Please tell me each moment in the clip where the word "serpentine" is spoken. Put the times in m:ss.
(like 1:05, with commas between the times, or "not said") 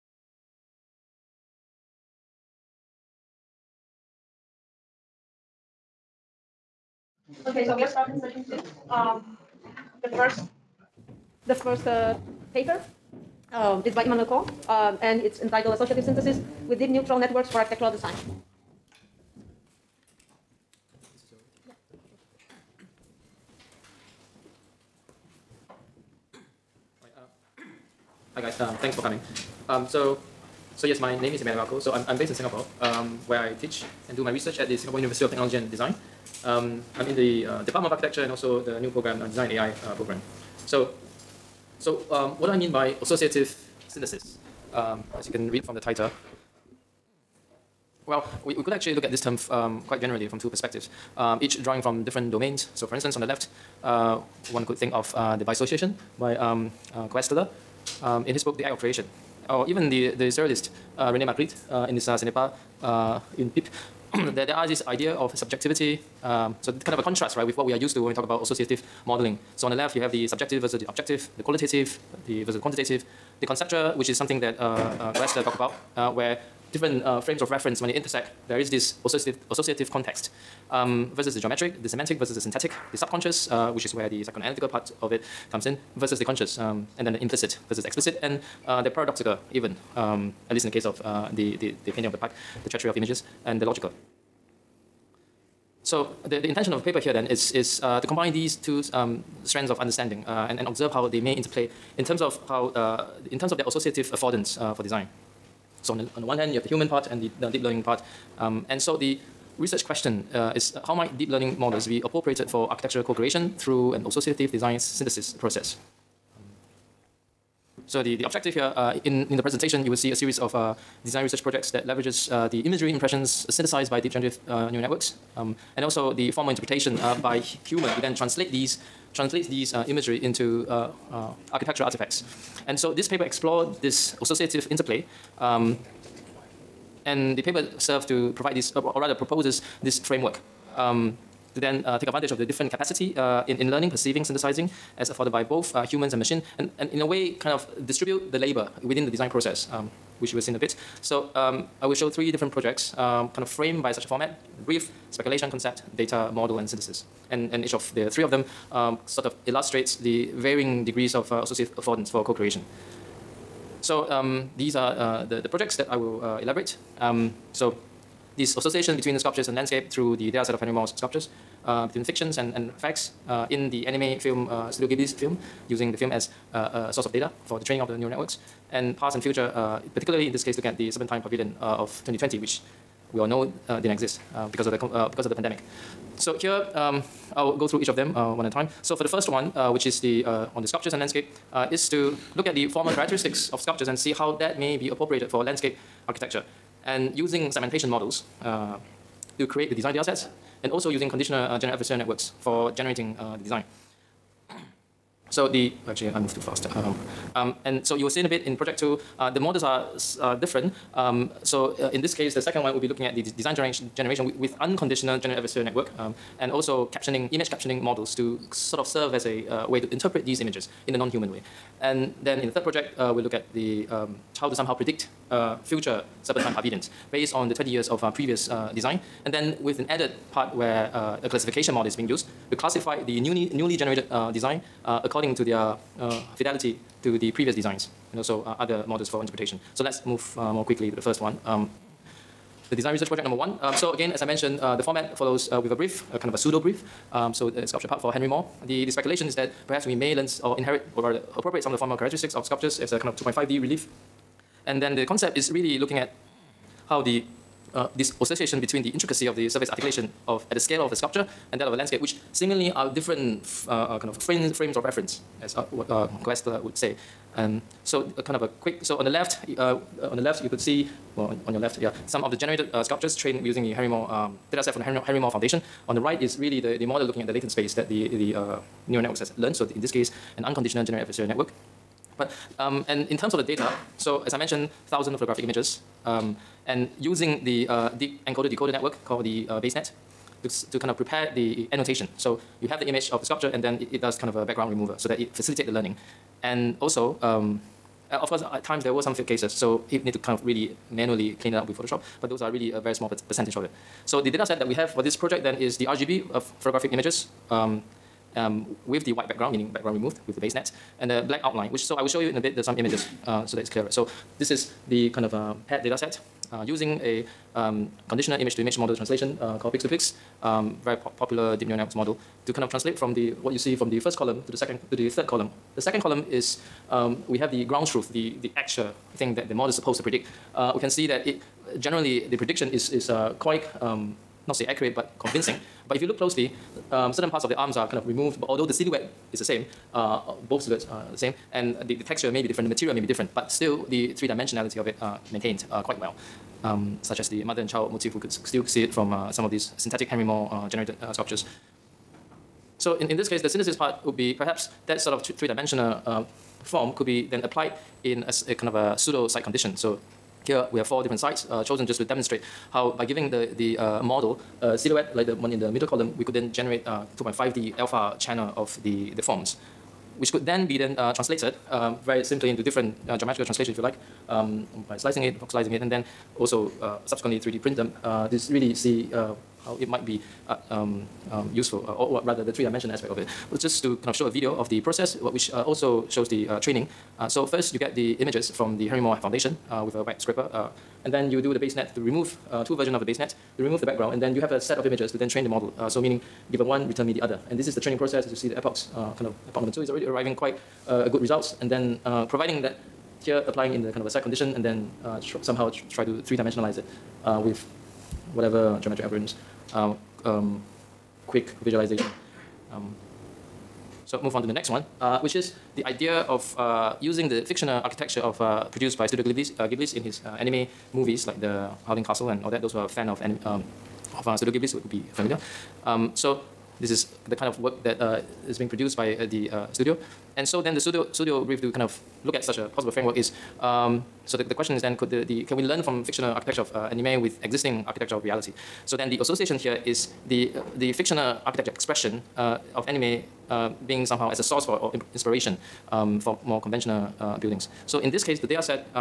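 3:00, 3:46.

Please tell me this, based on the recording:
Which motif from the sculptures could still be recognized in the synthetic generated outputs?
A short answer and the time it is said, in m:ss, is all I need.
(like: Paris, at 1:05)
mother and child, at 5:47.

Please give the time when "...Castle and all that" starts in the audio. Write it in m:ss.
7:02.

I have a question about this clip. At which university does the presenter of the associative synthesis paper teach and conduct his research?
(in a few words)
Singapore University of Technology and Design.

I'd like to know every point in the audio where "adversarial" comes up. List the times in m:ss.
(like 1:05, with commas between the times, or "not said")
3:21, 3:35, 4:41.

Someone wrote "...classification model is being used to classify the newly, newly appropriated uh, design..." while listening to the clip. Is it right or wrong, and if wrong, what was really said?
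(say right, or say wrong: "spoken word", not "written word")
wrong: "generated", not "appropriated".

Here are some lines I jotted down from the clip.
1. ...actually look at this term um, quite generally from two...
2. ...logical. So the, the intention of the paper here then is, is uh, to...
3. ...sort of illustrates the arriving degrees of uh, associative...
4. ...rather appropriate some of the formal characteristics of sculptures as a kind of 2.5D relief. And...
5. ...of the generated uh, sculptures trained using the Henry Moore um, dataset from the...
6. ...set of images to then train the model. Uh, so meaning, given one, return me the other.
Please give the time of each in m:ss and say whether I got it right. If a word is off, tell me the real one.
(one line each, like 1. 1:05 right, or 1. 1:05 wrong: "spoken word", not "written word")
1. 0:48 right
2. 1:33 right
3. 2:39 wrong: "varying", not "arriving"
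4. 4:11 right
5. 4:32 right
6. 6:34 right.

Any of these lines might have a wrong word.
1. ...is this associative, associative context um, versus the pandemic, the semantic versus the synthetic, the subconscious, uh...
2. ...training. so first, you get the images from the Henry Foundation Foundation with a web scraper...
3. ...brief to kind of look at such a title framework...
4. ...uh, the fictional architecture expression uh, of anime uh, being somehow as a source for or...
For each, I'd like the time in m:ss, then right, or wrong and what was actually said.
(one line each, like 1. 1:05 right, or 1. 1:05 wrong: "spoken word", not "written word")
1. 1:18 wrong: "geometric", not "pandemic"
2. 6:26 wrong: "Moore", not "Foundation"
3. 7:11 wrong: "possible", not "title"
4. 7:20 right.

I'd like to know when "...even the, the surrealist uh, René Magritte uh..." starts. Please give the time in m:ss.
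0:59.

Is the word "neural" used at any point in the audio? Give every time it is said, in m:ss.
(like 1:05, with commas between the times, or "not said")
0:16, 2:04, 2:57, 4:38, 5:21.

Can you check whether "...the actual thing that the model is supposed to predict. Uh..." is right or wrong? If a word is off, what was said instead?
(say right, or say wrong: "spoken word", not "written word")
right.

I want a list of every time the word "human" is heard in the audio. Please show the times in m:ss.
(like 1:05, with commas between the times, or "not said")
1:46, 2:07, 2:25, 3:40.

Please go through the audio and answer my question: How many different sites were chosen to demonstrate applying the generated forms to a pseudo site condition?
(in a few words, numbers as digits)
4.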